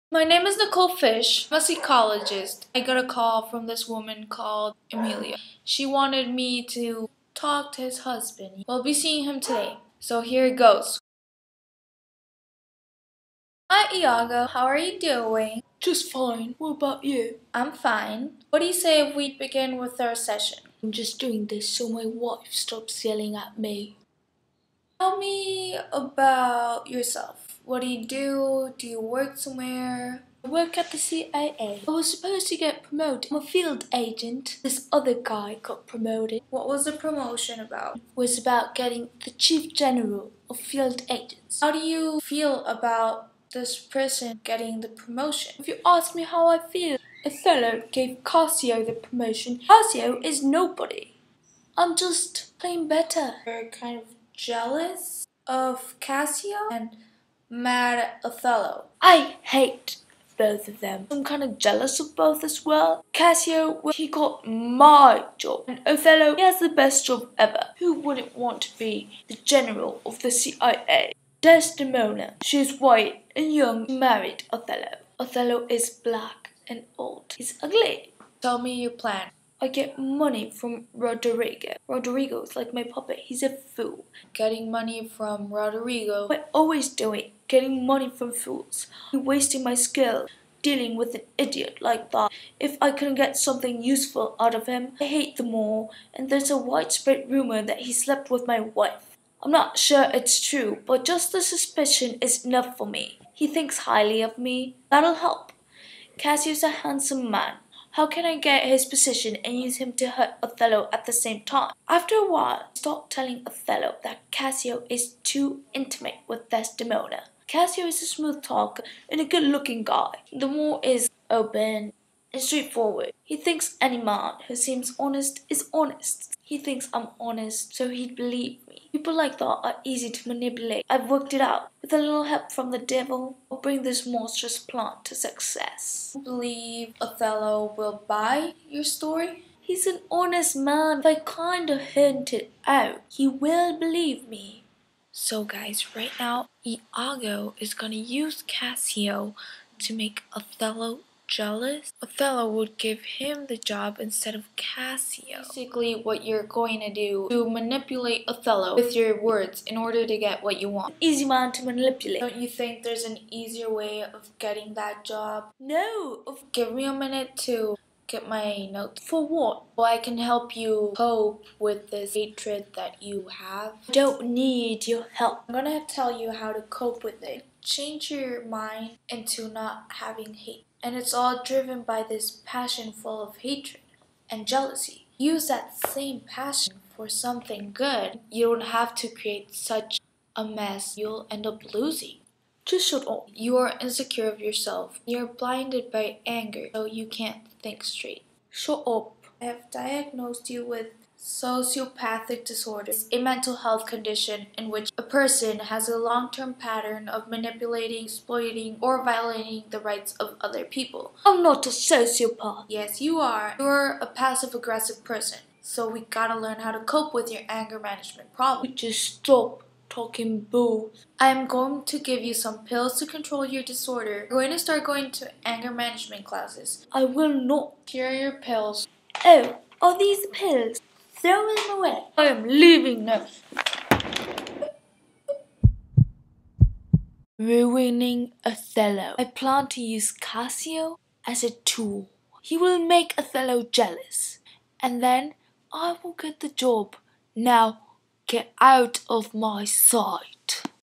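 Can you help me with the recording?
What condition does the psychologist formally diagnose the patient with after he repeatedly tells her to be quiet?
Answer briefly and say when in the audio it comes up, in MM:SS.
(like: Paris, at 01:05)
Sociopathic disorder, at 03:21.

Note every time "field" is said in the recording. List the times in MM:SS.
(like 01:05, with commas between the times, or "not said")
00:33, 00:40.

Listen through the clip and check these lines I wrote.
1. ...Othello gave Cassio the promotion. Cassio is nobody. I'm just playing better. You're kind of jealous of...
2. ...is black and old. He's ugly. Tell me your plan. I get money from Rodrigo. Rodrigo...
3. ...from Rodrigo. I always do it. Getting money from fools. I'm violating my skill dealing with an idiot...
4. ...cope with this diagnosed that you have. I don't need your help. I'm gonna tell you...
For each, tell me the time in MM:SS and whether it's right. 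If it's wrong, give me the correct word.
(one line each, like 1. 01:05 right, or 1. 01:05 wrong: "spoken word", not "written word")
1. 00:47 right
2. 01:15 right
3. 01:25 wrong: "wasting", not "violating"
4. 02:50 wrong: "hatred", not "diagnosed".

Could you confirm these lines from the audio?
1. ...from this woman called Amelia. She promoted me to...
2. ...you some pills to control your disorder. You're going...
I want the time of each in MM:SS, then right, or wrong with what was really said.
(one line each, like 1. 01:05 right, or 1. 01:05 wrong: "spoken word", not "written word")
1. 00:03 wrong: "wanted", not "promoted"
2. 03:42 right.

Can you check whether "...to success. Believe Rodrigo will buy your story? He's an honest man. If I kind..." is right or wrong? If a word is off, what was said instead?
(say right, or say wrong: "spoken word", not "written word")
wrong: "Othello", not "Rodrigo".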